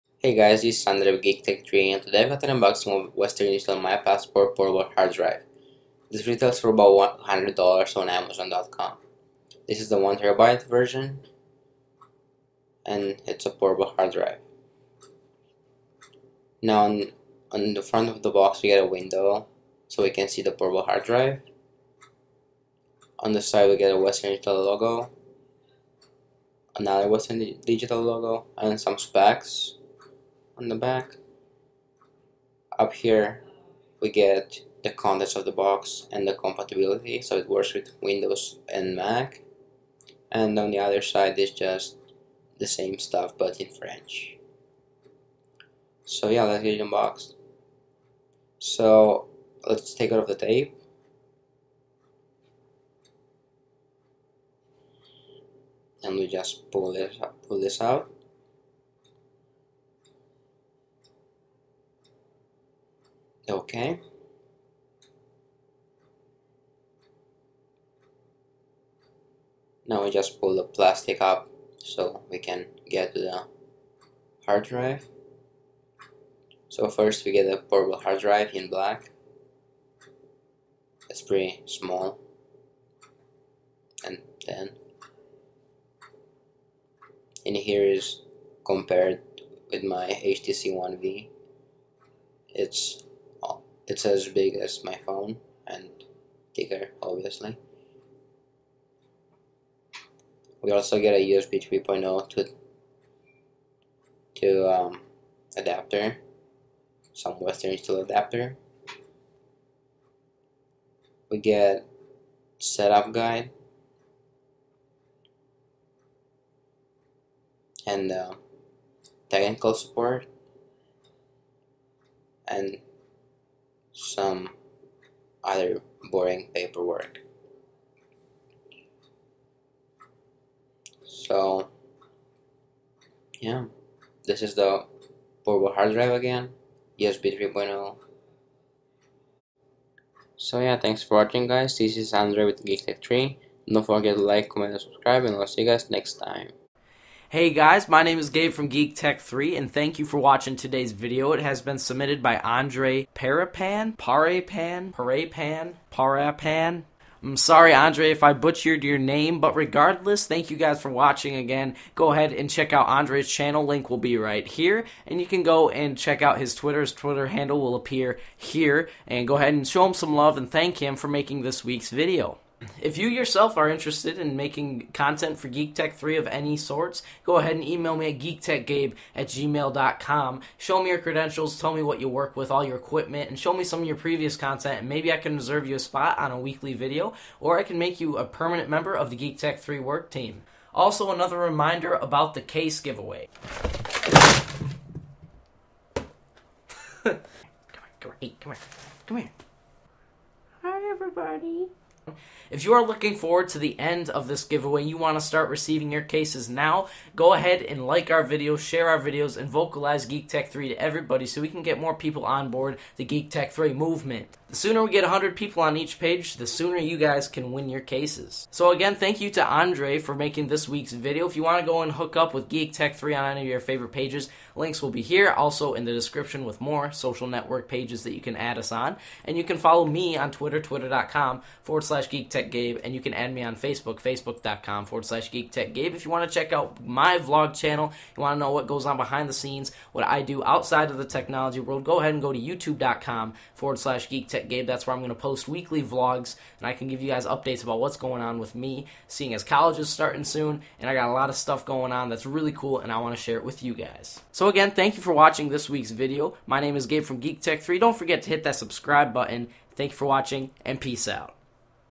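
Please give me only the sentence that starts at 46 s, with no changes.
So yeah, let's get it unboxed.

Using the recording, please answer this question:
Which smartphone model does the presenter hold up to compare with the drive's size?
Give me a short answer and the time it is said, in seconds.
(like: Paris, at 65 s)
HTC One V, at 90 s.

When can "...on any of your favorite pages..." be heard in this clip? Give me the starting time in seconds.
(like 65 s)
223 s.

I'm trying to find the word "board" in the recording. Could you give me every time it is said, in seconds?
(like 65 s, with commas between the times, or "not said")
212 s.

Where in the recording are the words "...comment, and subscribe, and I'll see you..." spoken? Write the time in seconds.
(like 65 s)
144 s.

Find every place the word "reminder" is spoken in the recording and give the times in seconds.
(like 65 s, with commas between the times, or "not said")
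191 s.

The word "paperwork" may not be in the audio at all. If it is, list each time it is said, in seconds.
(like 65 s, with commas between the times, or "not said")
126 s.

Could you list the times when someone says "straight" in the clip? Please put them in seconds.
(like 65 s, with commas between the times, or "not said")
not said.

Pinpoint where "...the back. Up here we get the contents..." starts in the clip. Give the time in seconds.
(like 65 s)
30 s.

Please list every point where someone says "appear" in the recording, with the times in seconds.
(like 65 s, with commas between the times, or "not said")
167 s.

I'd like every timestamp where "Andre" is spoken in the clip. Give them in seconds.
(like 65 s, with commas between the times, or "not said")
0 s, 142 s, 152 s, 157 s, 162 s, 219 s.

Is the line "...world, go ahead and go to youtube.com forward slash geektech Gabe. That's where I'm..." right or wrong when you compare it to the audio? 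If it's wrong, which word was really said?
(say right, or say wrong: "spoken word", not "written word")
right.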